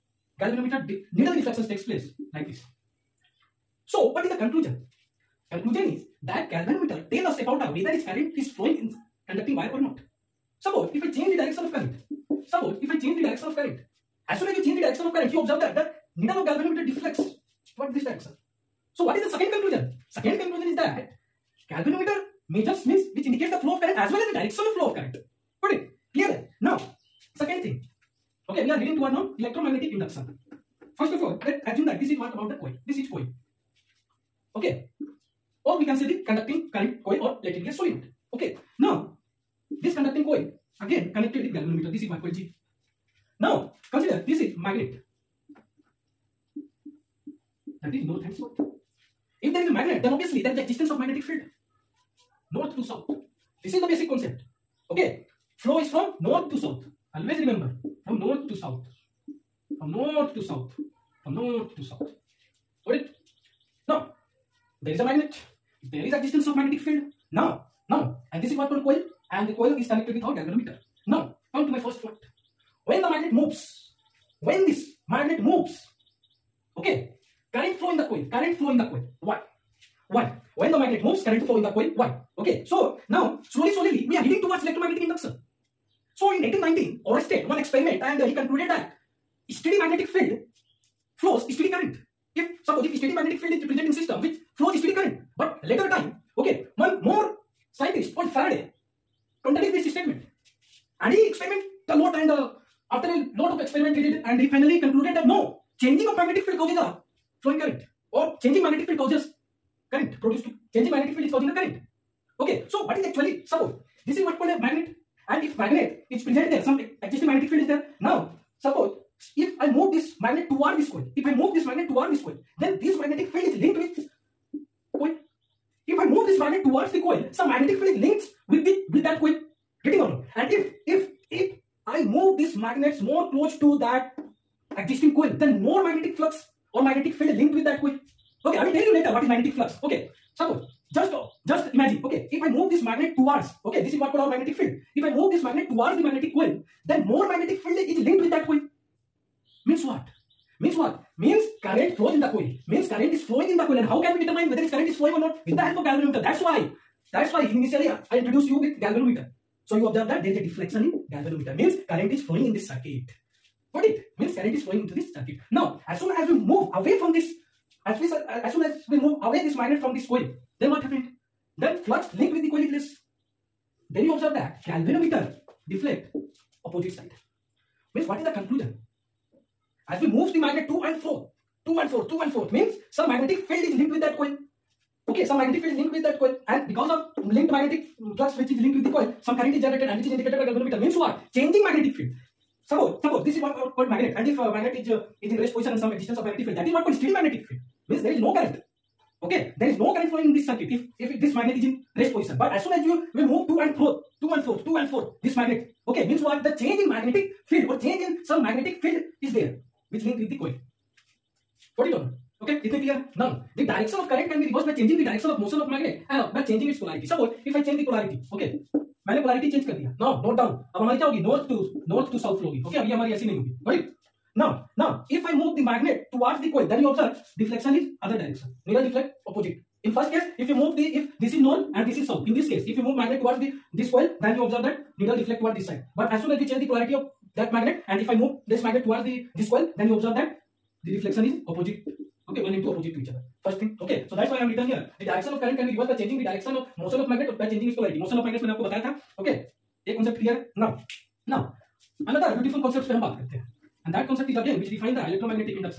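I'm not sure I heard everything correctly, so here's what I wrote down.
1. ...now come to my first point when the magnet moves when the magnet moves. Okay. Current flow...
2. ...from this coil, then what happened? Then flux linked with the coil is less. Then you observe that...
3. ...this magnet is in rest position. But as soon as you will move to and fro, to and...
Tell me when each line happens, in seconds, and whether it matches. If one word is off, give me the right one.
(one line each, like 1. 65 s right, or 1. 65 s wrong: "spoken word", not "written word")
1. 71 s right
2. 169 s right
3. 201 s right.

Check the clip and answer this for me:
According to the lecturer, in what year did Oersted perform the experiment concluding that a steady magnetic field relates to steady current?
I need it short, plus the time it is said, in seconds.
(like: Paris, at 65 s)
1819, at 86 s.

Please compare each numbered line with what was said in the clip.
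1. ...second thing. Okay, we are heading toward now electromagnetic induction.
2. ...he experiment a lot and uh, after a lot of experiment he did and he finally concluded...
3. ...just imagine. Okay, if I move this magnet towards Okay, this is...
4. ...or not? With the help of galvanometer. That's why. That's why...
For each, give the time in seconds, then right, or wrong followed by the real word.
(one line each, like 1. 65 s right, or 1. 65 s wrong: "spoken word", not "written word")
1. 27 s right
2. 101 s right
3. 141 s right
4. 155 s right.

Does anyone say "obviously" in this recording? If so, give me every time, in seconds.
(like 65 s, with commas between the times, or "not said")
50 s.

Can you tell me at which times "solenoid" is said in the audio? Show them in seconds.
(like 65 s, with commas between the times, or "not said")
37 s.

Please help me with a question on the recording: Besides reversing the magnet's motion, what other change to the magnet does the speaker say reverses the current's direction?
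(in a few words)
Changing its polarity.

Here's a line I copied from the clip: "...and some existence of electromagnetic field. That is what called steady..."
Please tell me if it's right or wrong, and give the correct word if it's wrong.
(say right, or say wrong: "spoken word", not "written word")
wrong: "magnetic", not "electromagnetic".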